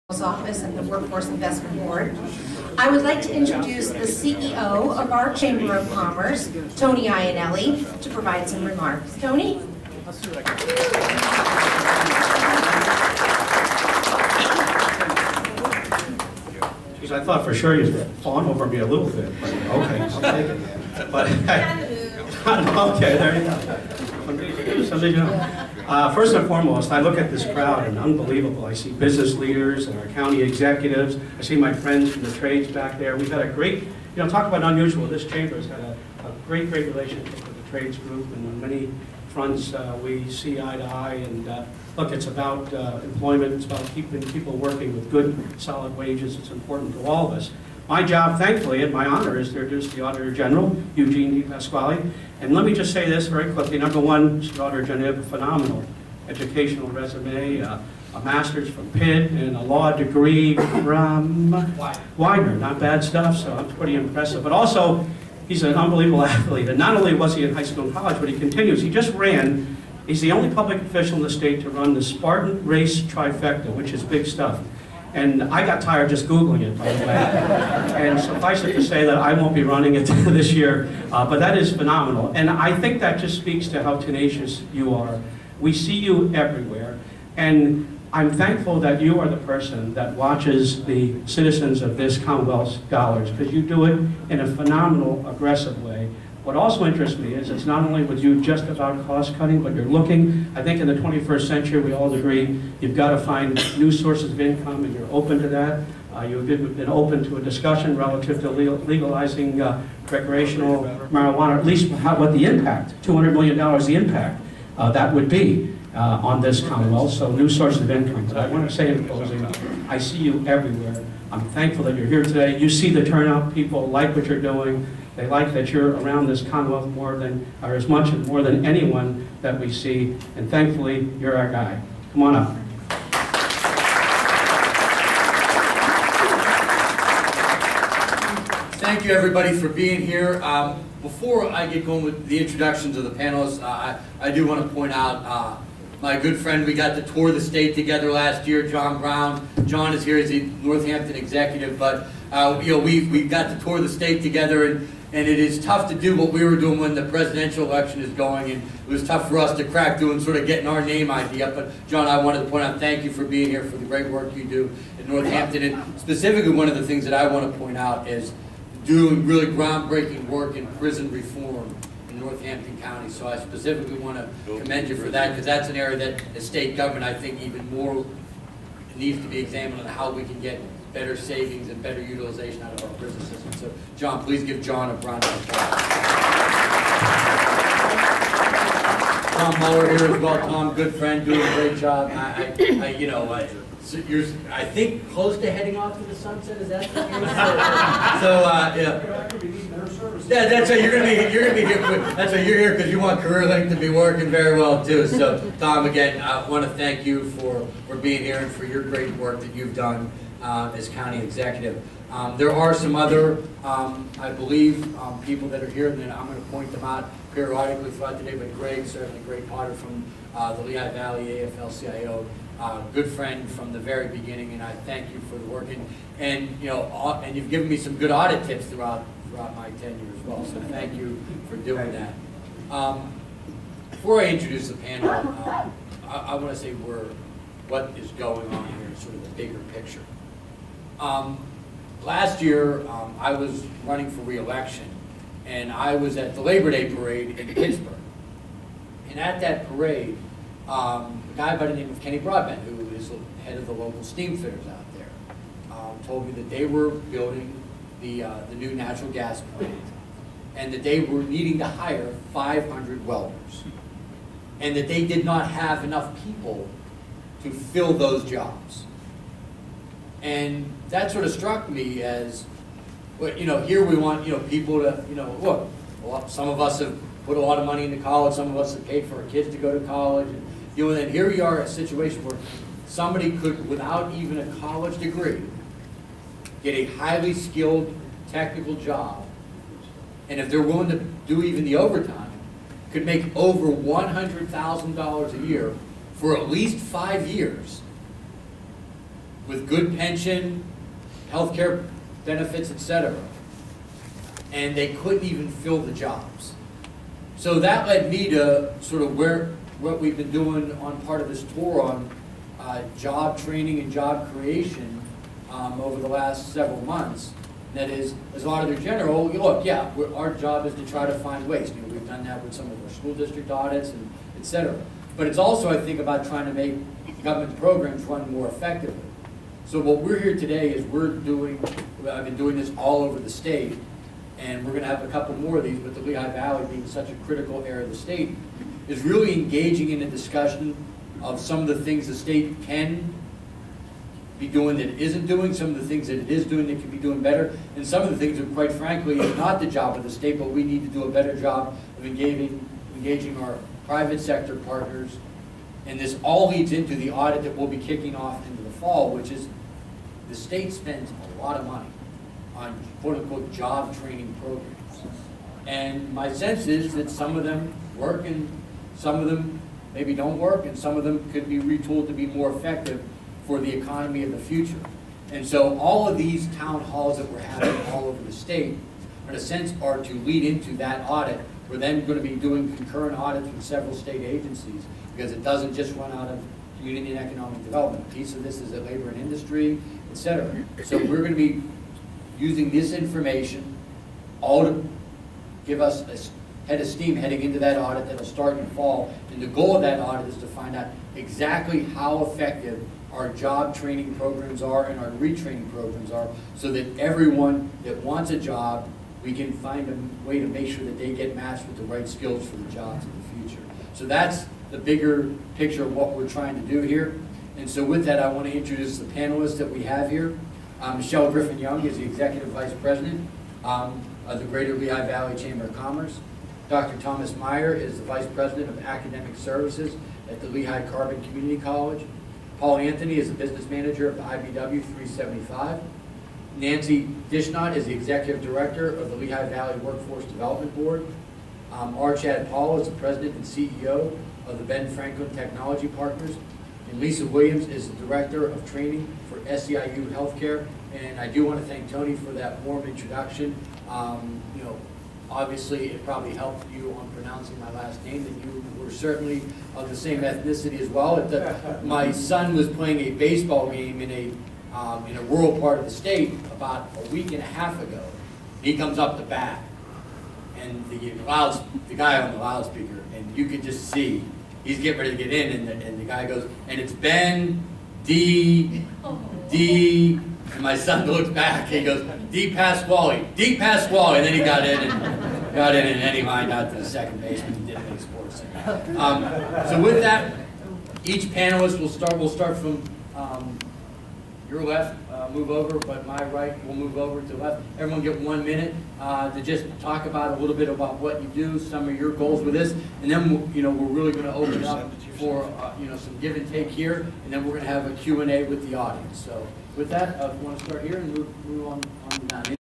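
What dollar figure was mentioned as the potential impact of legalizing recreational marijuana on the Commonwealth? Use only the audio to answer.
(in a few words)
$200 million.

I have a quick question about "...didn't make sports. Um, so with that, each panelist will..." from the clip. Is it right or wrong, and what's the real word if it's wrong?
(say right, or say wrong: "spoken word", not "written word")
right.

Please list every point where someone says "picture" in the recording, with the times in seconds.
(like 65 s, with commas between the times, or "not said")
239 s, 415 s.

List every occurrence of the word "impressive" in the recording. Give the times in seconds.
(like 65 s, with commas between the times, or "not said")
63 s.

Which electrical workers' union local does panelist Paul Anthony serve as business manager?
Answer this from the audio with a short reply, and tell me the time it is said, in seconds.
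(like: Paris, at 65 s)
IBEW 375, at 434 s.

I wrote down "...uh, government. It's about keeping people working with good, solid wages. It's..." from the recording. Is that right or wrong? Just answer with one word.
wrong.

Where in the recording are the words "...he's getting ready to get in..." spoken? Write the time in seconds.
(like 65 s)
474 s.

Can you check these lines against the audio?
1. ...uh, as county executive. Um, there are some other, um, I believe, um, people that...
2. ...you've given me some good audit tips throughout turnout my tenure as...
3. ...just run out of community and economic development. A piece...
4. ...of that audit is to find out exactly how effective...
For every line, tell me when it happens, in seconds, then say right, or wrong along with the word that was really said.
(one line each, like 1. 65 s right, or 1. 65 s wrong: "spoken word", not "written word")
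1. 210 s right
2. 227 s wrong: "throughout", not "turnout"
3. 385 s right
4. 399 s right.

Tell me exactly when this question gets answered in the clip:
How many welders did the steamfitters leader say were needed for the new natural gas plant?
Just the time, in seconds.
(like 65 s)
262 s.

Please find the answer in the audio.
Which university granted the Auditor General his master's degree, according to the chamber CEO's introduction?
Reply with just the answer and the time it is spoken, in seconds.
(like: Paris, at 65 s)
Pitt, at 58 s.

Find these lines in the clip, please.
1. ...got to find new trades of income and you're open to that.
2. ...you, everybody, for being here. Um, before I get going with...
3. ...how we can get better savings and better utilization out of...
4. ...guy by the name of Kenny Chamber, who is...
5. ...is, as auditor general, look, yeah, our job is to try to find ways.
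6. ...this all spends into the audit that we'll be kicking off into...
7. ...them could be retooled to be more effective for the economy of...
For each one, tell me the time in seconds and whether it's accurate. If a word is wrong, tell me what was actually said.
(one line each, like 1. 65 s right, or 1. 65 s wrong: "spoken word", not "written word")
1. 102 s wrong: "sources", not "trades"
2. 139 s right
3. 179 s right
4. 251 s wrong: "Broadbent", not "Chamber"
5. 317 s right
6. 355 s wrong: "leads", not "spends"
7. 371 s right.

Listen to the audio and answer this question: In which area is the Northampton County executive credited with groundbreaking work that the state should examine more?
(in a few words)
Prison reform.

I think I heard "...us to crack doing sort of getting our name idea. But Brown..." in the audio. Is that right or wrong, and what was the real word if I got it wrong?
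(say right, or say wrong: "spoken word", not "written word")
wrong: "John", not "Brown".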